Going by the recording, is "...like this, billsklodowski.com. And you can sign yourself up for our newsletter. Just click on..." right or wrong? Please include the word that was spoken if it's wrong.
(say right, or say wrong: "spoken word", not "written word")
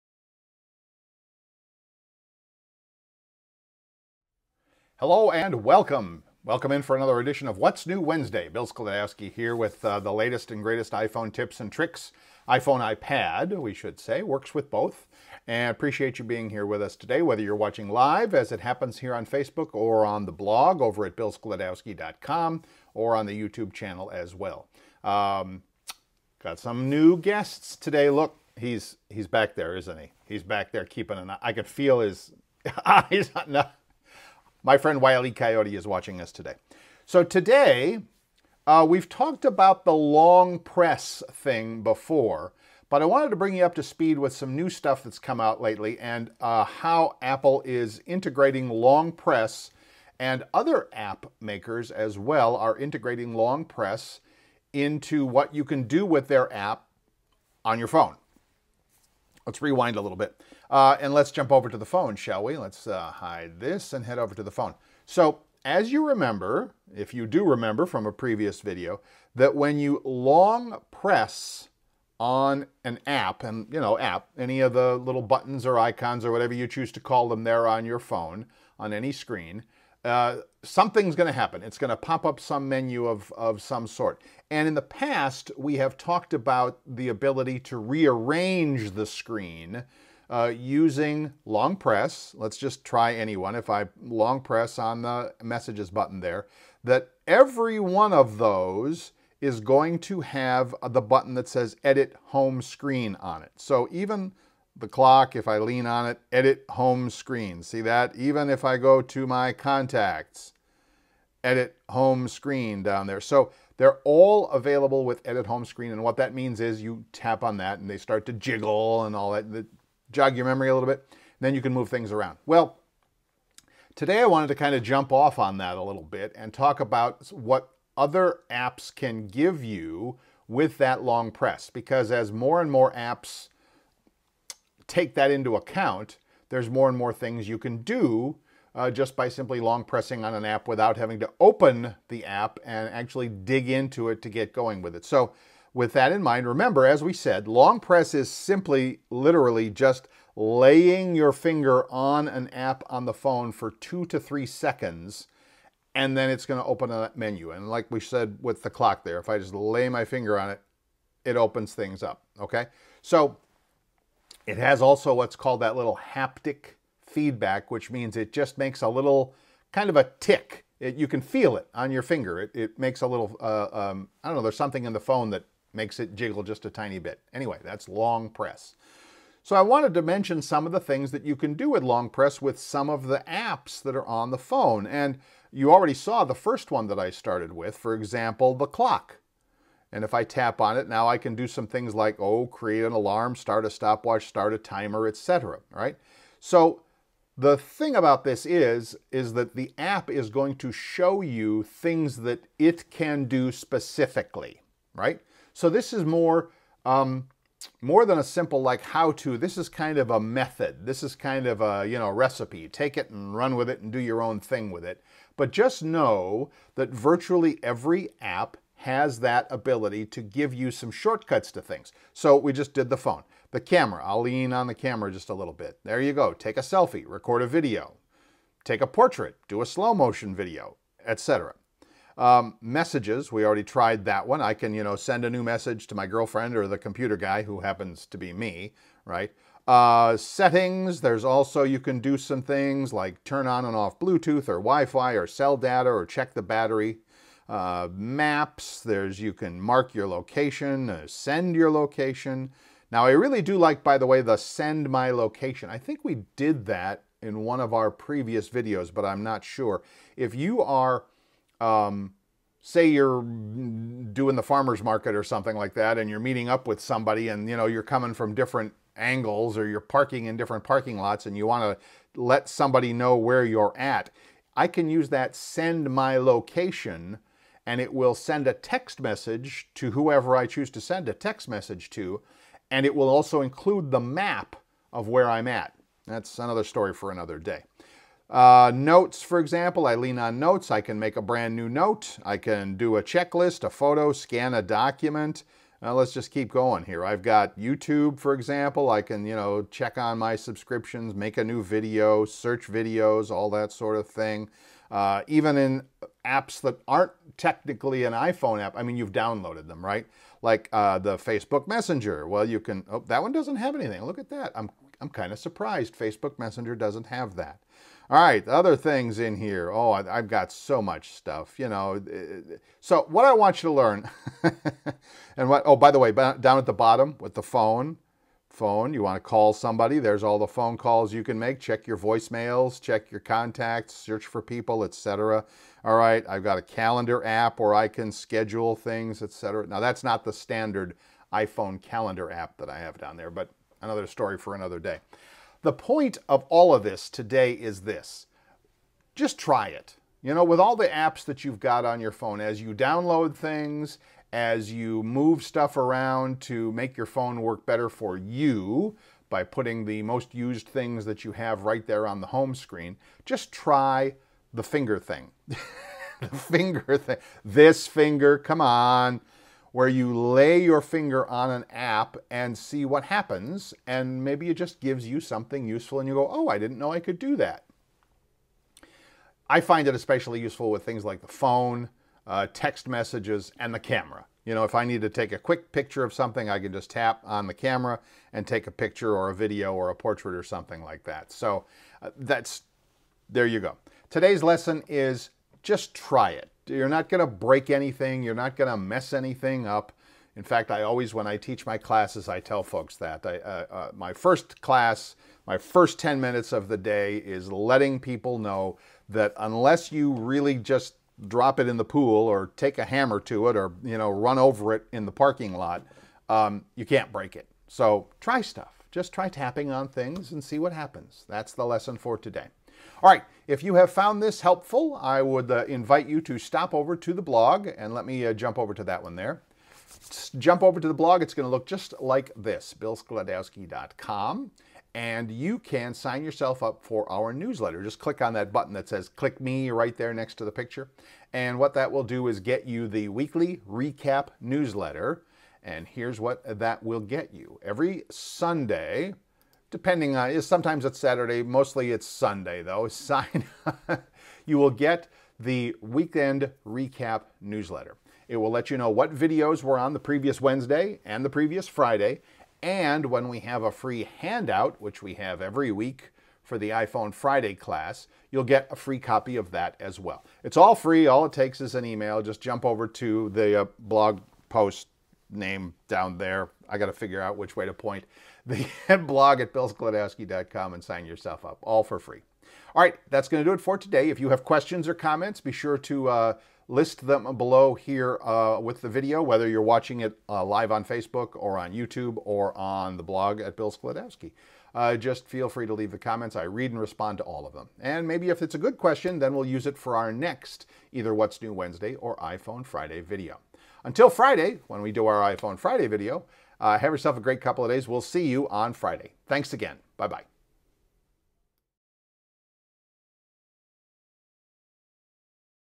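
right.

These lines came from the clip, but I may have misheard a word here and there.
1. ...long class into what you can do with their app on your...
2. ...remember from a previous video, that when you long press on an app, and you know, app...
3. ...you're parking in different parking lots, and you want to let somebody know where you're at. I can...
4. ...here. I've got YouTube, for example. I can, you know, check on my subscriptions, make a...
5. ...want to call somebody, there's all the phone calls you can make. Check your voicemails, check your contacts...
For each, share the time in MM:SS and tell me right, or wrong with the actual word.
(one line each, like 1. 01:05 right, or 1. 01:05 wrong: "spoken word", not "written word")
1. 00:53 wrong: "press", not "class"
2. 01:07 right
3. 04:29 right
4. 04:56 right
5. 05:29 right.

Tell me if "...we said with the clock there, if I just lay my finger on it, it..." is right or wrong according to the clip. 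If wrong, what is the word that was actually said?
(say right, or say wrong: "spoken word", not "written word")
right.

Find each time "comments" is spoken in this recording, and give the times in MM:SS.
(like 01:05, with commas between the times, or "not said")
08:04, 08:15.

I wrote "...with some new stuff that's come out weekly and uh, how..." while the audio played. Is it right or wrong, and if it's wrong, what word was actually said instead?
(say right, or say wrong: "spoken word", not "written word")
wrong: "lately", not "weekly".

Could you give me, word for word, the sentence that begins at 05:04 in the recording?
Uh, even in apps that aren't technically an iPhone app, I mean, you've downloaded them, right?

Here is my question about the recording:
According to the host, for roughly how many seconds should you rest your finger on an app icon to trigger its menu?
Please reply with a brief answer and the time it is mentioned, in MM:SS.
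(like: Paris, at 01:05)
2 to 3, at 02:33.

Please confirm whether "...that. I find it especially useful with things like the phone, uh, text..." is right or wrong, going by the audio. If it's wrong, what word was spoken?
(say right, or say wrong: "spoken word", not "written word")
right.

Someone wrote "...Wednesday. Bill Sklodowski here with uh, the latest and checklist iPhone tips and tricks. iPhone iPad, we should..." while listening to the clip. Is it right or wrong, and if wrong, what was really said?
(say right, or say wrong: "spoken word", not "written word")
wrong: "greatest", not "checklist".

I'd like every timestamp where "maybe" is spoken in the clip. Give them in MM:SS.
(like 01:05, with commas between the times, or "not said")
06:14, 08:18.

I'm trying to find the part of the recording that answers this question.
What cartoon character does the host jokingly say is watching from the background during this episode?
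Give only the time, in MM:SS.
00:35.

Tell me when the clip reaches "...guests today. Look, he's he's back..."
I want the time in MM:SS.
00:27.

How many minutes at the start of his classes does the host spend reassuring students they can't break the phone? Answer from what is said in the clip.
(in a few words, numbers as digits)
10.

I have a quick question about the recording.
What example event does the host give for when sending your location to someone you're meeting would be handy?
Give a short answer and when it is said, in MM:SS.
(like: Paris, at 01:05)
farmer's market, at 04:24.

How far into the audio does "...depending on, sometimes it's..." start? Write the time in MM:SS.
07:29.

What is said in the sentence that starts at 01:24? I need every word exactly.
And in the past, we have talked about the ability to rearrange the screen uh, using long press.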